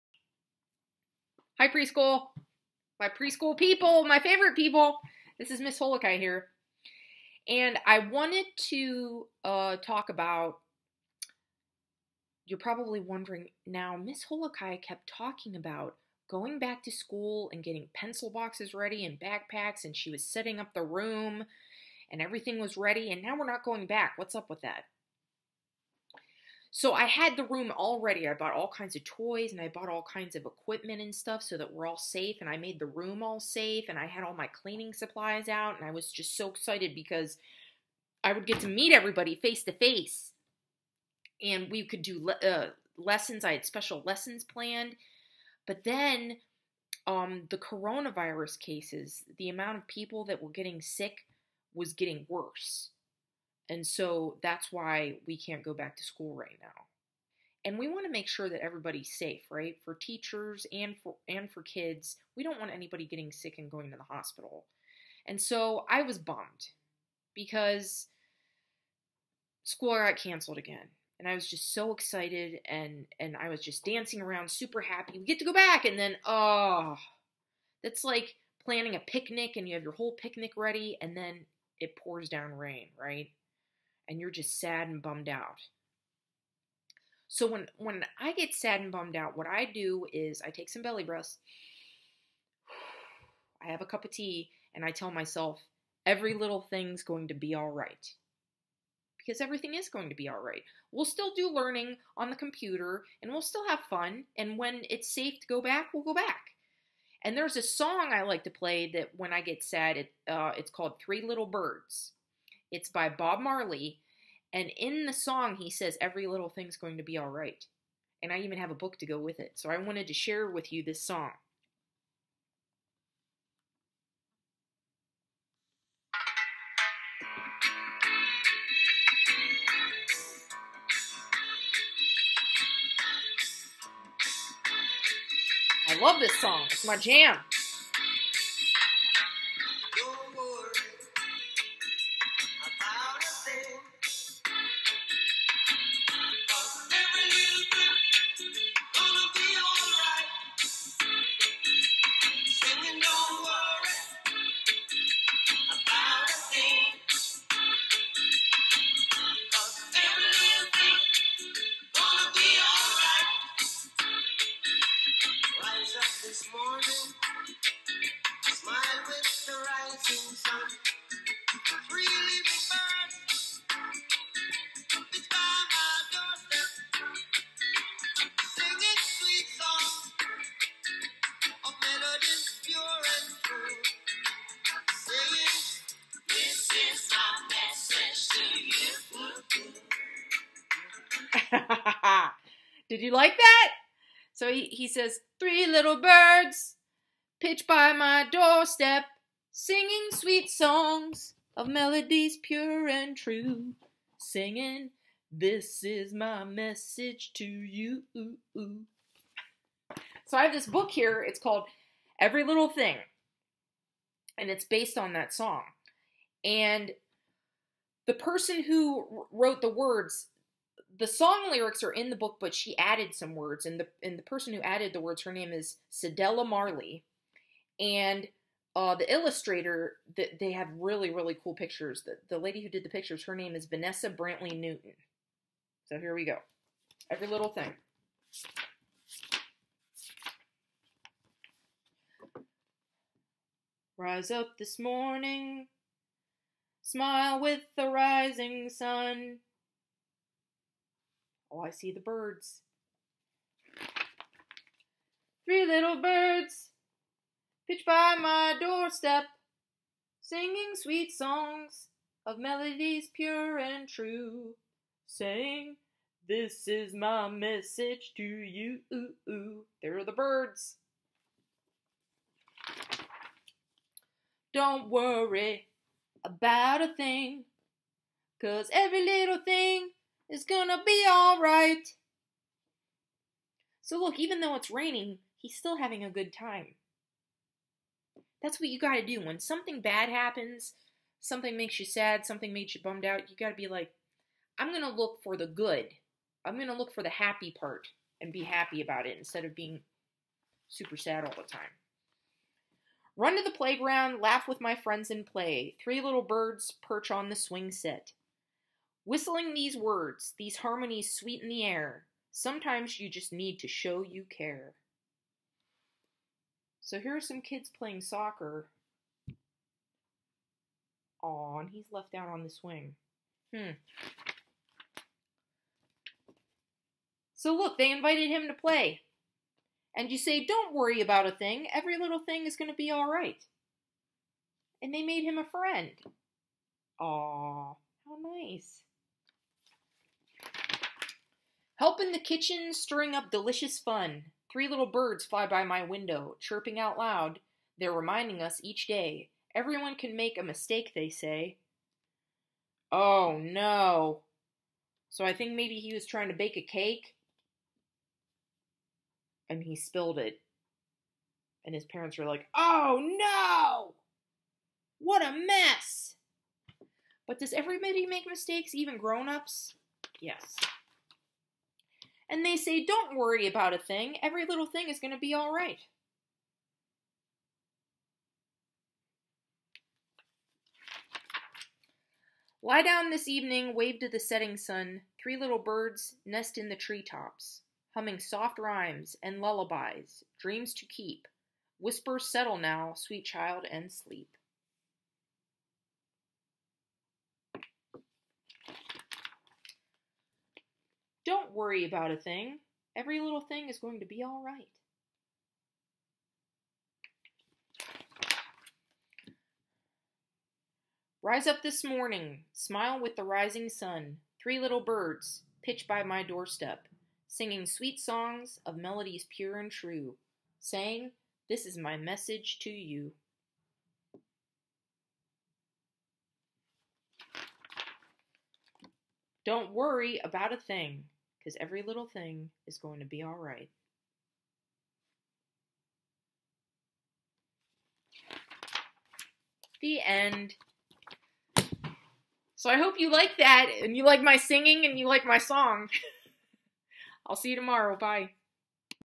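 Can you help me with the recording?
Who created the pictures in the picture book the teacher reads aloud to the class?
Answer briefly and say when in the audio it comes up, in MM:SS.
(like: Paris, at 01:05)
Vanessa Brantley Newton, at 03:53.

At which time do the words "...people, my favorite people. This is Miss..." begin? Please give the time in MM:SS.
00:03.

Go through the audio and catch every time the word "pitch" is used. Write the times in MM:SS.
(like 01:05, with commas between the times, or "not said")
03:17, 06:55.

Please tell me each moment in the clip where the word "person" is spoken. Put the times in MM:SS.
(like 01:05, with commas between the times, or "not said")
03:38, 03:44.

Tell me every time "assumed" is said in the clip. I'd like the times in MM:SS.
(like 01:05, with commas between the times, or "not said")
not said.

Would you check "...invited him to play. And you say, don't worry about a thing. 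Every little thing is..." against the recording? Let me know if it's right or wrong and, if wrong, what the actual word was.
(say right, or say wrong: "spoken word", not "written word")
right.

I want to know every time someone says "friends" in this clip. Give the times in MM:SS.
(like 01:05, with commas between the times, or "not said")
05:04, 05:35.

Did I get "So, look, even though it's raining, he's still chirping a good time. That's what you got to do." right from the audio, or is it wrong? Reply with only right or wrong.
wrong.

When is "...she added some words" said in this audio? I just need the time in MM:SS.
03:42.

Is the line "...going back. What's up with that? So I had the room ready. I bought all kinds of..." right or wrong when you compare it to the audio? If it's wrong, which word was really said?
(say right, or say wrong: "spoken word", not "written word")
wrong: "already", not "ready".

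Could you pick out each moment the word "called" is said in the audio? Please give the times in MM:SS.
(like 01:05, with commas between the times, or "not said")
01:50, 03:31.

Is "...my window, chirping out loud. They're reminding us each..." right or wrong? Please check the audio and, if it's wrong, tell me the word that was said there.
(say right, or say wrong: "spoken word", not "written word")
right.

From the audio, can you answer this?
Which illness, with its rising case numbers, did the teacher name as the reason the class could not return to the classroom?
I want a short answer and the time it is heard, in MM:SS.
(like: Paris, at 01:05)
coronavirus, at 00:47.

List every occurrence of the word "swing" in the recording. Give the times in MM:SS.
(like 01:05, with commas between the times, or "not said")
05:07, 05:22.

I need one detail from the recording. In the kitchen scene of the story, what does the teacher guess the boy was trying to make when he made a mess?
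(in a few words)
A cake.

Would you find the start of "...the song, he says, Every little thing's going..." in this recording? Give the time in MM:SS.
01:55.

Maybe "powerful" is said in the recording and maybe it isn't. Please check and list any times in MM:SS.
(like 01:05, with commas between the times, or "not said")
not said.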